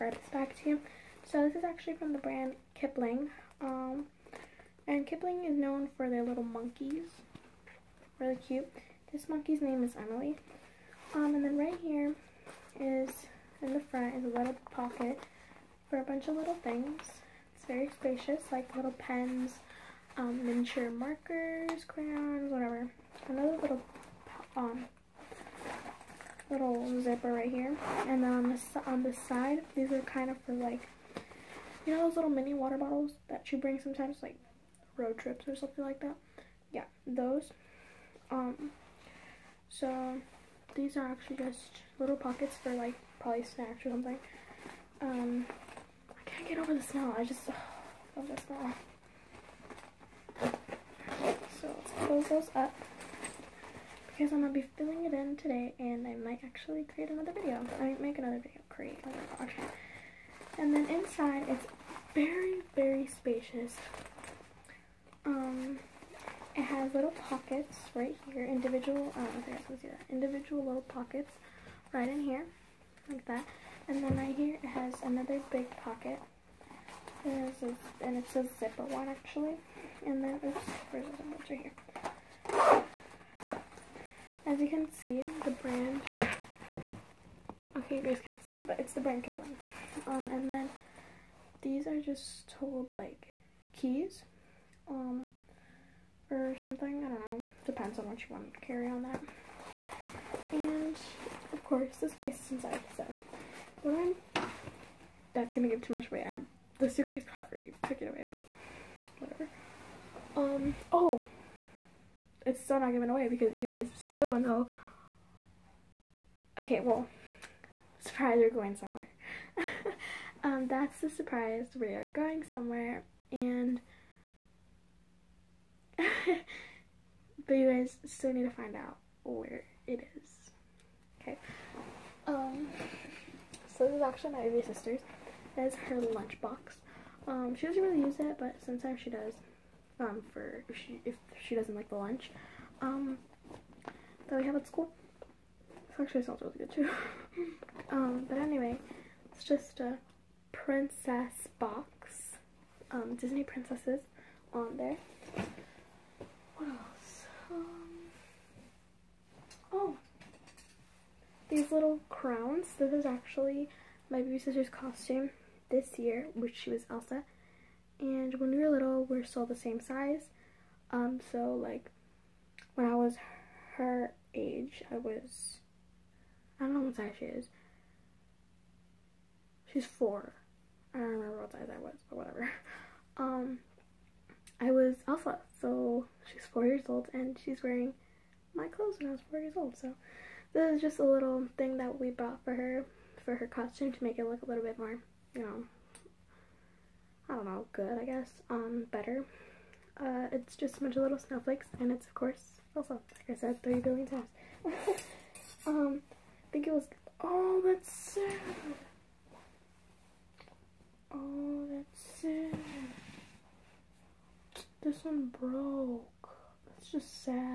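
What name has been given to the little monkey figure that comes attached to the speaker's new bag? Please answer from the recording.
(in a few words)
Emily.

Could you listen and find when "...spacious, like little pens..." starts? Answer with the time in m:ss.
0:17.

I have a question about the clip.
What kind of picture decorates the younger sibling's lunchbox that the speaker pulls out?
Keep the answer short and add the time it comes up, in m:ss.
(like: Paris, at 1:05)
Disney princesses, at 2:33.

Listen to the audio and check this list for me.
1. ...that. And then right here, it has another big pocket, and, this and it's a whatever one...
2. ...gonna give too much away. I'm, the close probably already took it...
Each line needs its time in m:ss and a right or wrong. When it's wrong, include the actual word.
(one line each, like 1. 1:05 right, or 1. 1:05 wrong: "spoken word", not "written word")
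1. 1:13 wrong: "zipper", not "whatever"
2. 1:45 wrong: "suitcase", not "close".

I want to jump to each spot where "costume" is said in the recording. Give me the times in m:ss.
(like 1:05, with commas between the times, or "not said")
2:44, 3:13.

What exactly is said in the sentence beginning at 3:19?
Uh, it's just a bunch of little snowflakes and it's of course Elsa, like I said 30 billion times.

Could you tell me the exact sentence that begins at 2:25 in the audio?
This actually smells really good too.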